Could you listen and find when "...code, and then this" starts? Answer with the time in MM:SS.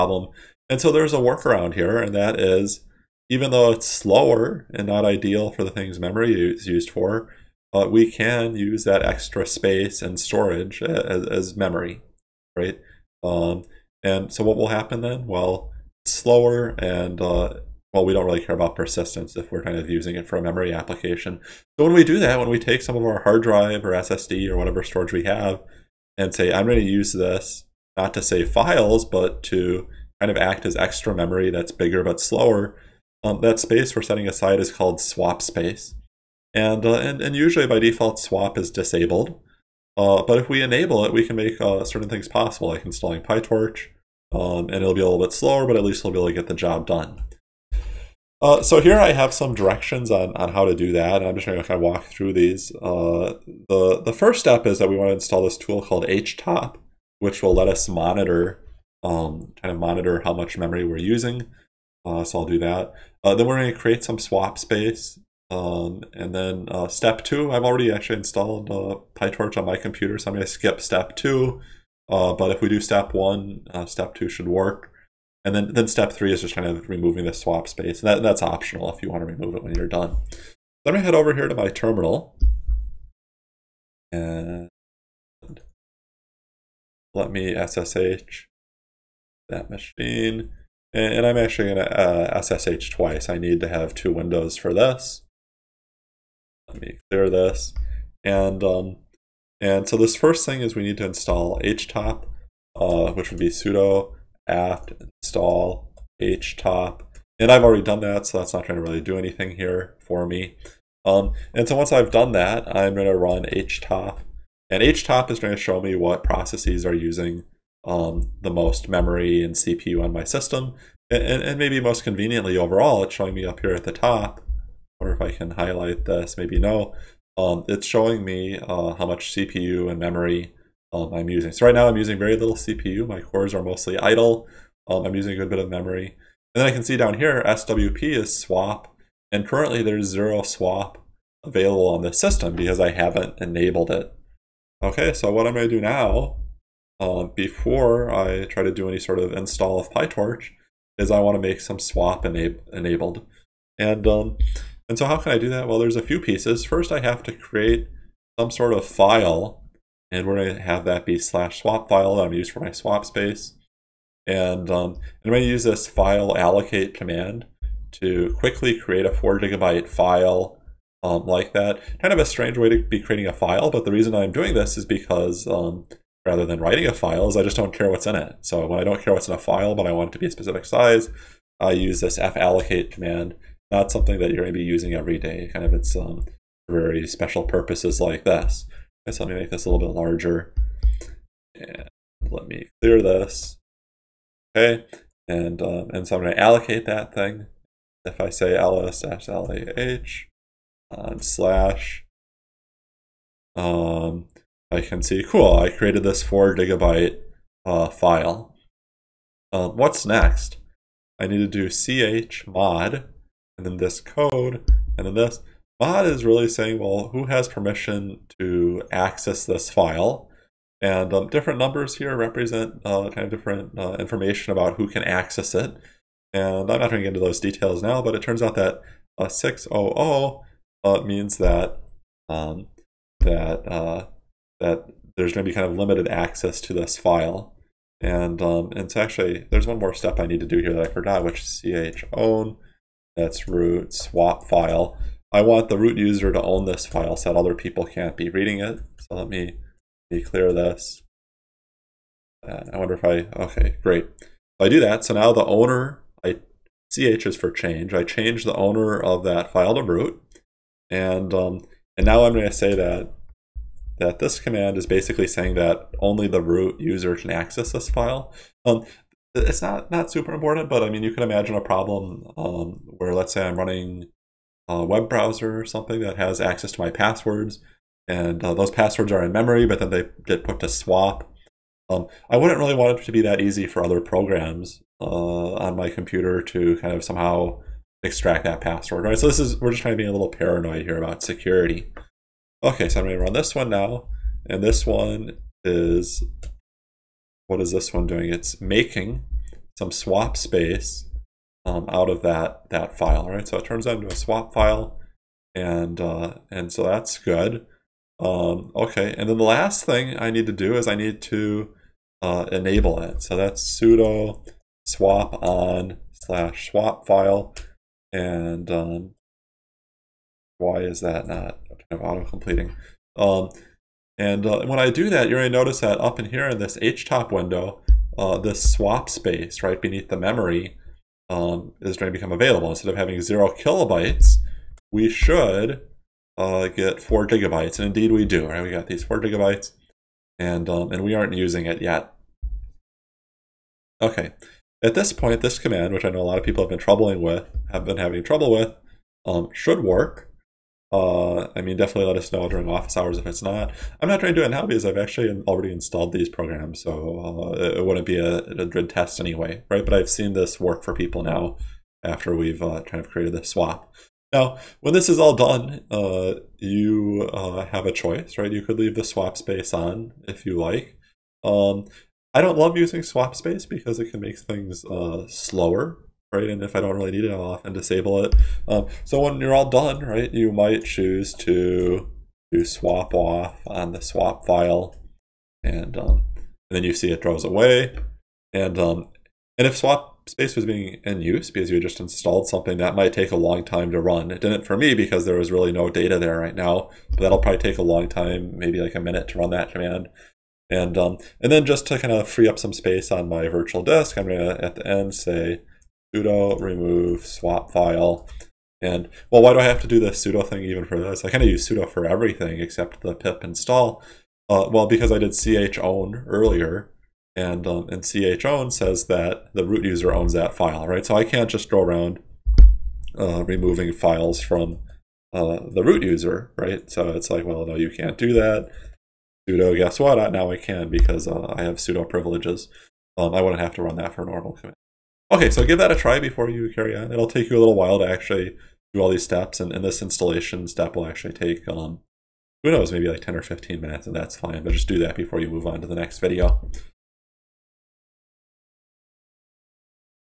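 03:34.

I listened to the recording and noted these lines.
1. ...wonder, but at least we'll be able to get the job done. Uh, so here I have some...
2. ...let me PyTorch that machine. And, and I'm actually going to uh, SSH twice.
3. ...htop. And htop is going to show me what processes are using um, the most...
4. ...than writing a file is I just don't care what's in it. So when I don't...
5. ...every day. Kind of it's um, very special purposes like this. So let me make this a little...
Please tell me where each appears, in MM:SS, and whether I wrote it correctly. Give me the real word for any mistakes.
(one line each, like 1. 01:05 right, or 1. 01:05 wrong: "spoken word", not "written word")
1. 00:45 wrong: "slower", not "wonder"
2. 01:27 wrong: "SSH", not "PyTorch"
3. 01:53 right
4. 02:56 right
5. 03:04 right.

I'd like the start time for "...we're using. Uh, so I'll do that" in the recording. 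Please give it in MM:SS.
01:00.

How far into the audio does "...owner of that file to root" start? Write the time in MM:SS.
04:18.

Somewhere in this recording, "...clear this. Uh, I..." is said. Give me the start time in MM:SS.
04:10.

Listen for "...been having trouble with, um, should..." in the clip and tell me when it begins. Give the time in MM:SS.
05:47.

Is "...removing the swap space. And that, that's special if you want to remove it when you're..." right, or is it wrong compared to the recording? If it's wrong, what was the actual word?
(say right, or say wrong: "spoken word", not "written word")
wrong: "optional", not "special".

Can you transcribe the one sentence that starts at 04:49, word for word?
So this is, we're just trying to be a little paranoid here about security.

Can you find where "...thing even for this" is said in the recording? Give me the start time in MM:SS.
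06:50.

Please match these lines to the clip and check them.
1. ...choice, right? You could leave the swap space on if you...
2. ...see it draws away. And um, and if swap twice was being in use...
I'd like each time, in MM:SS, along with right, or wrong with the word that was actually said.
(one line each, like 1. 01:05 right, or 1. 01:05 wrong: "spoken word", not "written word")
1. 06:07 right
2. 06:26 wrong: "space", not "twice".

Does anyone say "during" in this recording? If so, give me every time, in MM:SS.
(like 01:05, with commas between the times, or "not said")
05:52.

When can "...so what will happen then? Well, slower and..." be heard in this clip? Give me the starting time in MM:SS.
00:14.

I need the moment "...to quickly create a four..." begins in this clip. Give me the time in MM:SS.
02:47.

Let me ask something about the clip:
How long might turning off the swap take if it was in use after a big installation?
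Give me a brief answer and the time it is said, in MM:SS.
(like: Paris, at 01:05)
a minute, at 06:38.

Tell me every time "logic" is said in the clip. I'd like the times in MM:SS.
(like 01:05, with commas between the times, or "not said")
not said.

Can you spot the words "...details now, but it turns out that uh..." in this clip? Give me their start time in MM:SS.
03:47.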